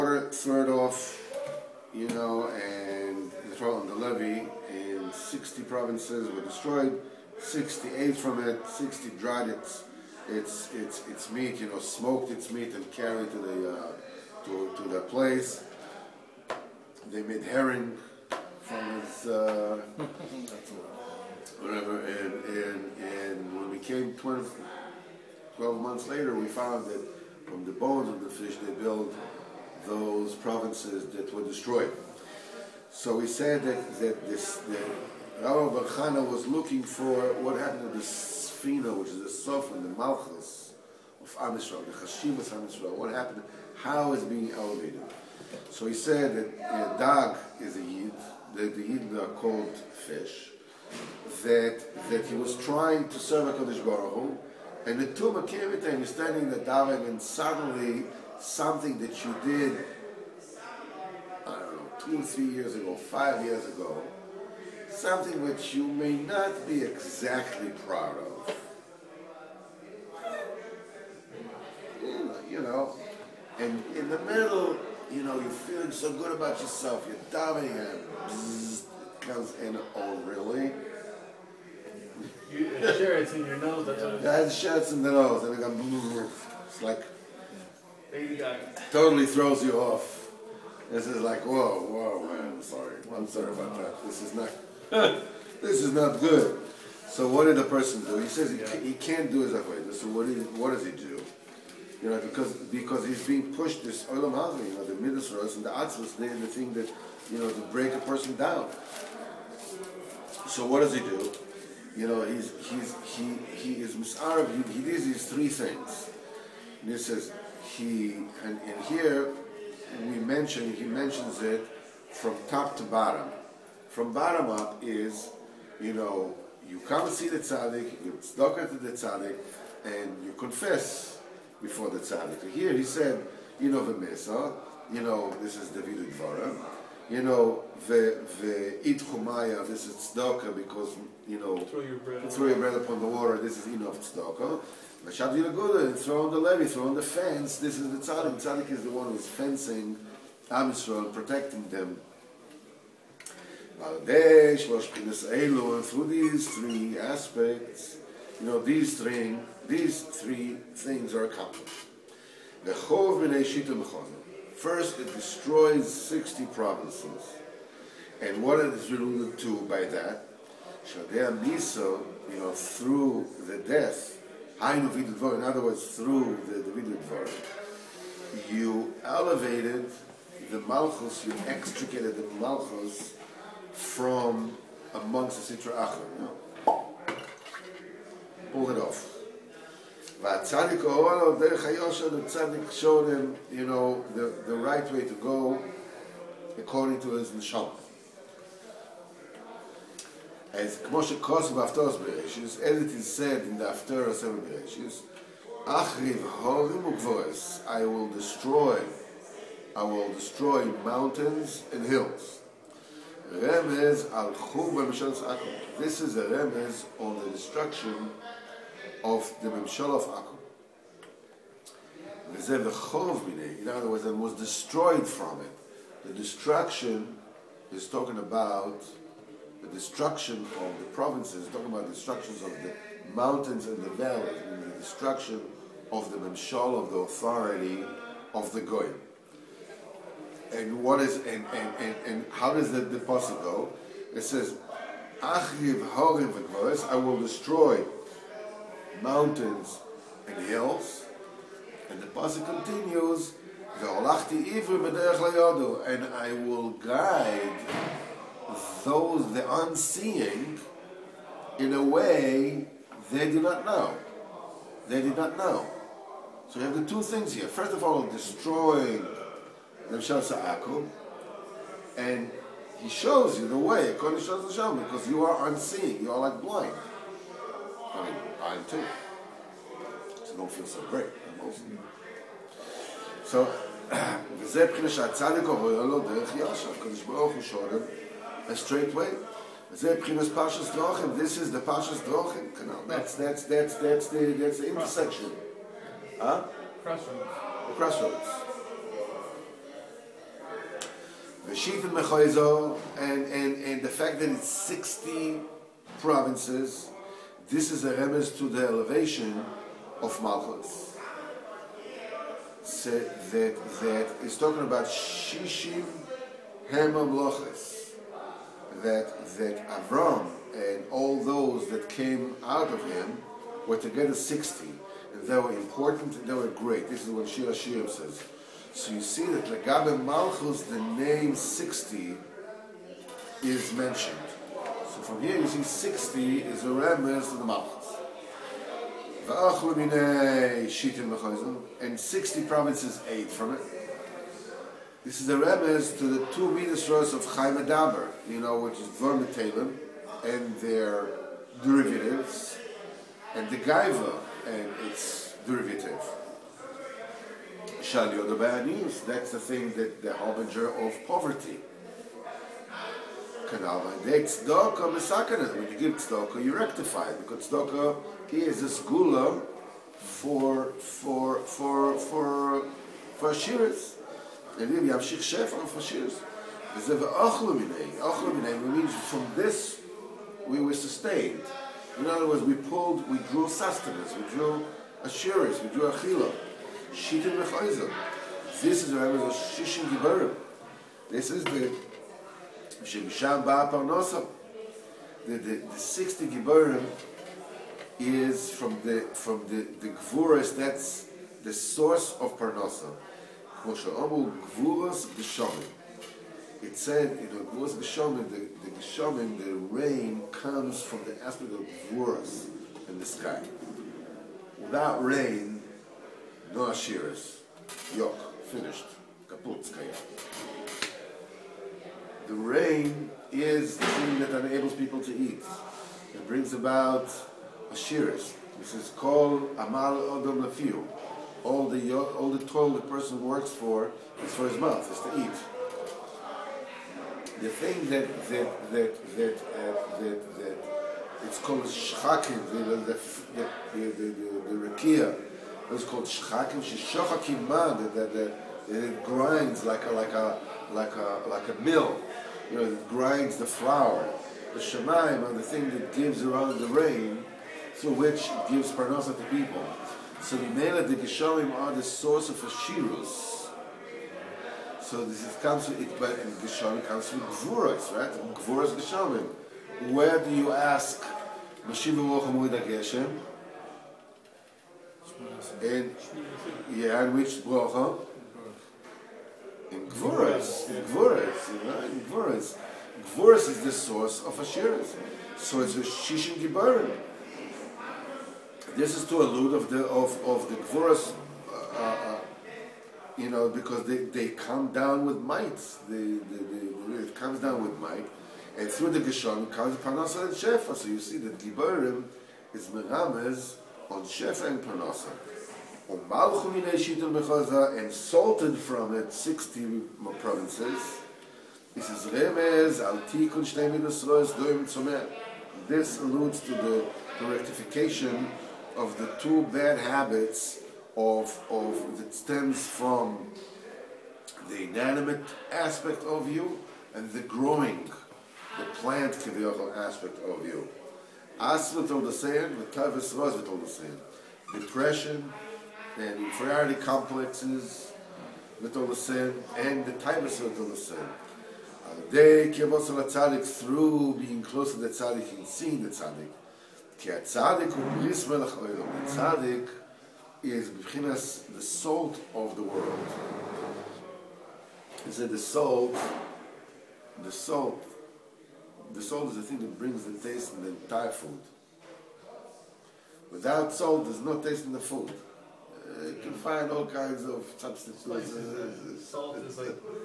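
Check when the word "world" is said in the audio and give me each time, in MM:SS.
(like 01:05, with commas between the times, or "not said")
09:12.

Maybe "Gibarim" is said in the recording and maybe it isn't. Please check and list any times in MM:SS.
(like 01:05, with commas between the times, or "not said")
06:29, 08:06, 08:21.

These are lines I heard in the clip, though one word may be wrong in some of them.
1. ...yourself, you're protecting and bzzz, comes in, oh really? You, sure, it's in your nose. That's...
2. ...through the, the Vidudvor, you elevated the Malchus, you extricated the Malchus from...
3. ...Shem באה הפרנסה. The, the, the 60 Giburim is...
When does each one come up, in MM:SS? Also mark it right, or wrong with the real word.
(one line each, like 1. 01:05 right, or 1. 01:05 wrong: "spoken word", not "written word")
1. 01:16 wrong: "diving", not "protecting"
2. 02:55 right
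3. 06:32 right.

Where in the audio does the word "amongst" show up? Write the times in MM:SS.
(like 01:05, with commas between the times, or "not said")
03:04.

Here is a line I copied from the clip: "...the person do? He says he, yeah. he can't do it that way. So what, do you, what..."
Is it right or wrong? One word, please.
right.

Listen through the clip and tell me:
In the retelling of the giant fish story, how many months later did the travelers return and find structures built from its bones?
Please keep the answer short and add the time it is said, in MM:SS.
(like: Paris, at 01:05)
12, at 00:25.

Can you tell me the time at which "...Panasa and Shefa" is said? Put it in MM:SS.
08:19.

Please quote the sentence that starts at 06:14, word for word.
And then you have shich shefer for shiris, there's a ochluminei.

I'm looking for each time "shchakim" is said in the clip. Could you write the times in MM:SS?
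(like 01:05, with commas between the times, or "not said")
07:21, 07:26.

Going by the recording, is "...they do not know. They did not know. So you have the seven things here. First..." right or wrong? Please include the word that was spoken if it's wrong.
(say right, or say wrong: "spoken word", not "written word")
wrong: "two", not "seven".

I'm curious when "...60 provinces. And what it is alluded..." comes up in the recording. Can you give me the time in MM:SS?
02:45.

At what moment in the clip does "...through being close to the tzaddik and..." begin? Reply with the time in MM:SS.
09:03.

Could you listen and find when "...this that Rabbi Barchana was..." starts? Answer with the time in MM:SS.
00:34.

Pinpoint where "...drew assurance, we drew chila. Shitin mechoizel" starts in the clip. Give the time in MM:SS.
06:24.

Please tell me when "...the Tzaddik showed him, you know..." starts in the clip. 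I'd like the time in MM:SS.
03:12.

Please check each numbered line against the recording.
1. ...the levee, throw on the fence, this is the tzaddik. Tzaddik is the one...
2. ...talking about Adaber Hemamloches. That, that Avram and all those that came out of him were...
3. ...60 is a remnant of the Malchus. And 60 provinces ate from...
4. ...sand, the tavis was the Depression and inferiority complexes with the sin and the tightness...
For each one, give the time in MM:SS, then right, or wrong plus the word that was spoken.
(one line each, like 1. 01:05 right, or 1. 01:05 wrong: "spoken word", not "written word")
1. 02:26 right
2. 05:14 wrong: "Shishim", not "Adaber"
3. 05:35 right
4. 08:52 right.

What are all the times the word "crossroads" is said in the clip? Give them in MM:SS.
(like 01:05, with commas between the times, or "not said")
04:56, 05:01.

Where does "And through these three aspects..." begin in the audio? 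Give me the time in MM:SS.
02:33.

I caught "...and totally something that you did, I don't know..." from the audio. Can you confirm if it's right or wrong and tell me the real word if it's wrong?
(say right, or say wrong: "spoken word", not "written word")
wrong: "suddenly", not "totally".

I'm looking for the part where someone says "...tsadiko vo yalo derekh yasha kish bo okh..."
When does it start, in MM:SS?
04:45.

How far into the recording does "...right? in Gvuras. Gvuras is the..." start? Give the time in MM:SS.
08:01.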